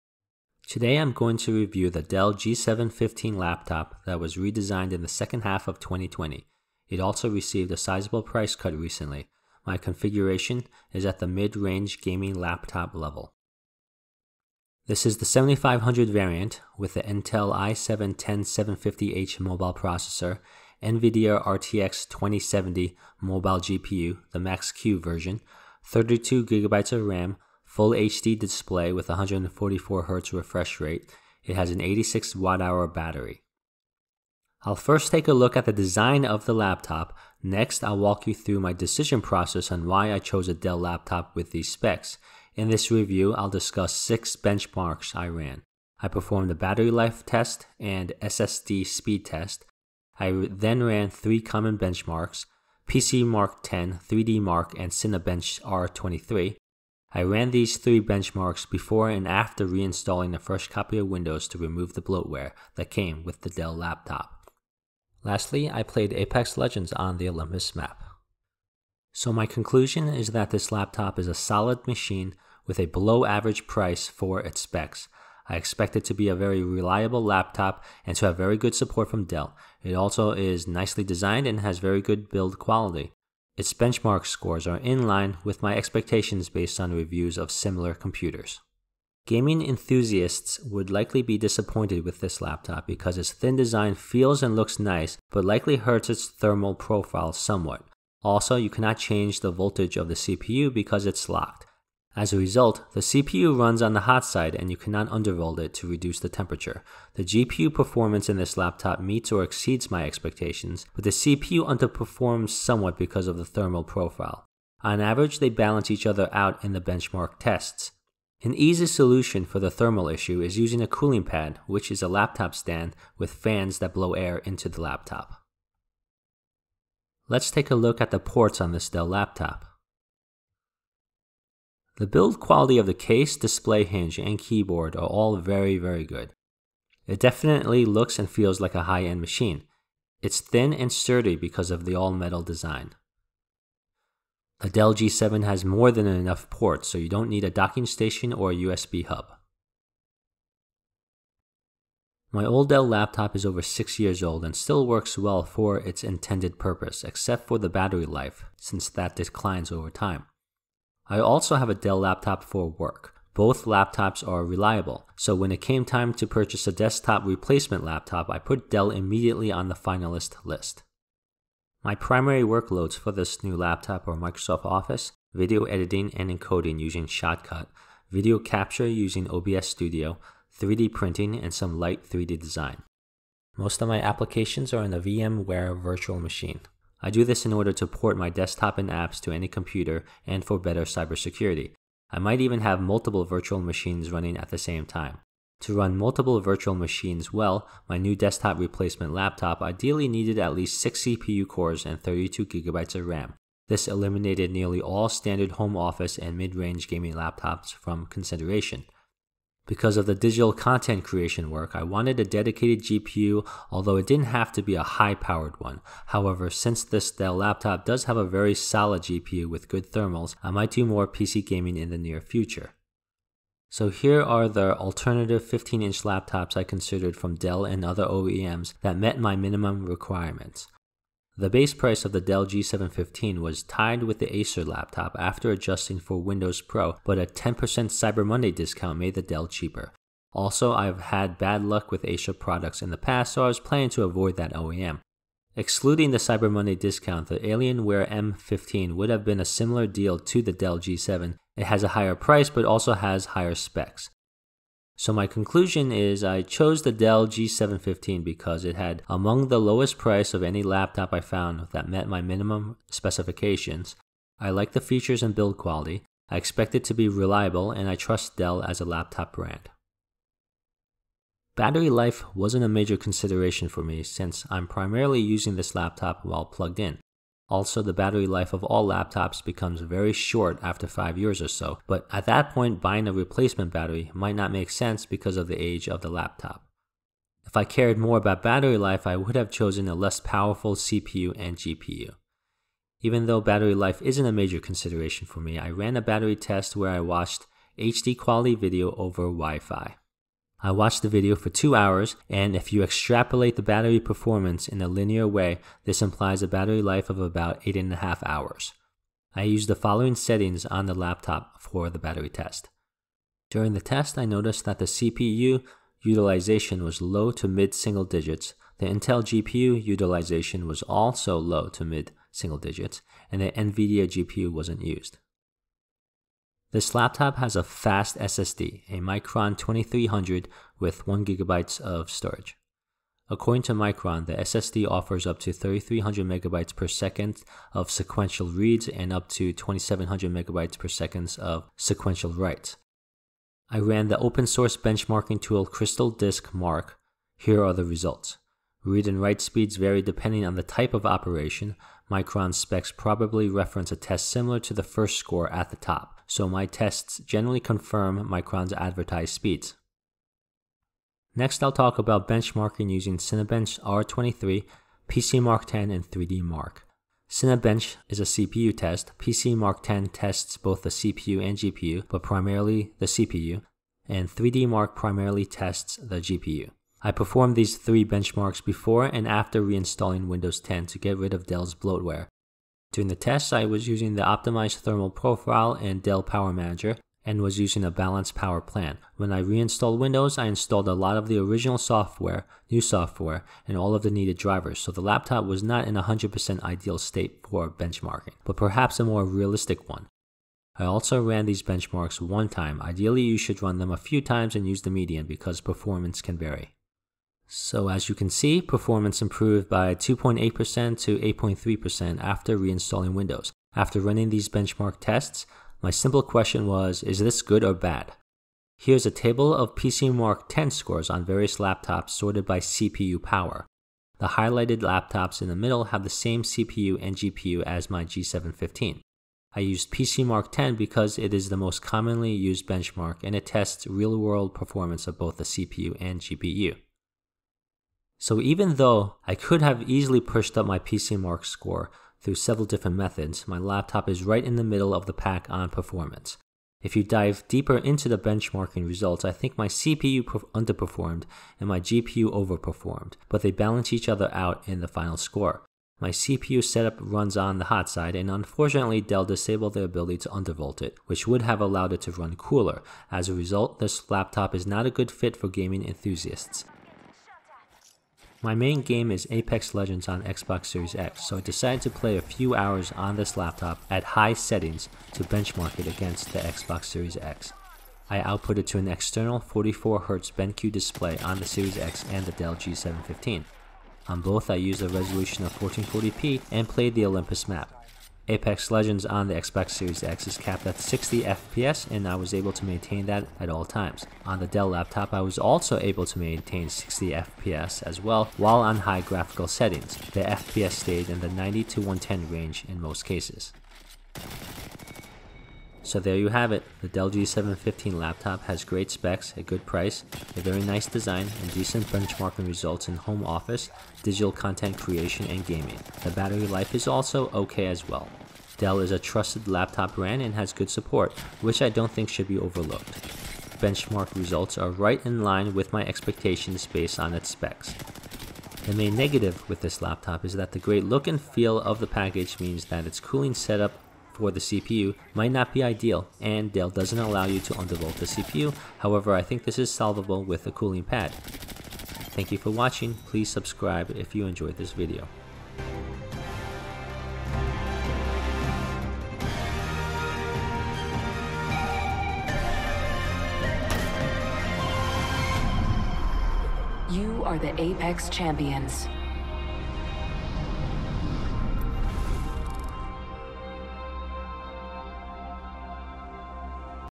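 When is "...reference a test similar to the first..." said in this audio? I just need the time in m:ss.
5:53.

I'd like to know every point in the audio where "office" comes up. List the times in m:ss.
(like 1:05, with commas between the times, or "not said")
2:54, 3:25, 8:33.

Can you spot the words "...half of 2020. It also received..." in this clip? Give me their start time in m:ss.
0:05.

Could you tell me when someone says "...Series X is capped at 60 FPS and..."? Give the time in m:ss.
8:09.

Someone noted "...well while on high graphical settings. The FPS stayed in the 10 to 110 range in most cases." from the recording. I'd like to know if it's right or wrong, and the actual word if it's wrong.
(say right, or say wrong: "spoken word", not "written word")
wrong: "90", not "10".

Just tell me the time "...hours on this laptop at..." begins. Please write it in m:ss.
7:52.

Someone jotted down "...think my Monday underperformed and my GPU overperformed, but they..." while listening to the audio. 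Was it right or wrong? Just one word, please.
wrong.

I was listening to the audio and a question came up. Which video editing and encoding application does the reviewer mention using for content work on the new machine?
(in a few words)
Shotcut.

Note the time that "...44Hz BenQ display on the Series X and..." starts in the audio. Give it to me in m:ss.
7:59.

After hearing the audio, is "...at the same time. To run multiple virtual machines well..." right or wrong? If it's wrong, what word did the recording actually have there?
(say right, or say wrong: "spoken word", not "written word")
right.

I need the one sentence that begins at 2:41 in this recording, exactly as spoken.
I also have a Dell laptop for work.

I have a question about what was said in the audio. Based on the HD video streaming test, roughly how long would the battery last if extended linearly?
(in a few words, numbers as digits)
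8.5 hours.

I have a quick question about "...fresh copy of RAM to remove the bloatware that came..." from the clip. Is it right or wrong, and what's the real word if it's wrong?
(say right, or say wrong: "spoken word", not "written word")
wrong: "Windows", not "RAM".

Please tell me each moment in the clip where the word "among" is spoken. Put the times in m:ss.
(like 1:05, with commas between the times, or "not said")
4:19.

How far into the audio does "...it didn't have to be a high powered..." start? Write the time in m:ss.
3:33.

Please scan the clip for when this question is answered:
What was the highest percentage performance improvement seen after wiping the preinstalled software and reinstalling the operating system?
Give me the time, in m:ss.
6:51.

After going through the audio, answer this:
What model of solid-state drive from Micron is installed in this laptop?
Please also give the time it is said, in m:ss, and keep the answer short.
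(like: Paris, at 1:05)
Micron 2300, at 5:29.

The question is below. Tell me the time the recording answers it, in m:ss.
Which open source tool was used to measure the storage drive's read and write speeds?
5:45.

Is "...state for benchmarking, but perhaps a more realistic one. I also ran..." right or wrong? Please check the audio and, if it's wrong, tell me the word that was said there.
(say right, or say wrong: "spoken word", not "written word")
right.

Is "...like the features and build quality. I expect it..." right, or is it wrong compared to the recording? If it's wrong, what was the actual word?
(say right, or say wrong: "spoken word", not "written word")
right.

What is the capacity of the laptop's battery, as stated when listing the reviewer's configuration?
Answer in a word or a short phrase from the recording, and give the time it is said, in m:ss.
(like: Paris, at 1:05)
86 watt hours, at 0:31.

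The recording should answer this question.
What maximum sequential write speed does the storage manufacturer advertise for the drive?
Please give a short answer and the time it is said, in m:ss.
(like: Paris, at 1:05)
2700 megabytes per second, at 5:39.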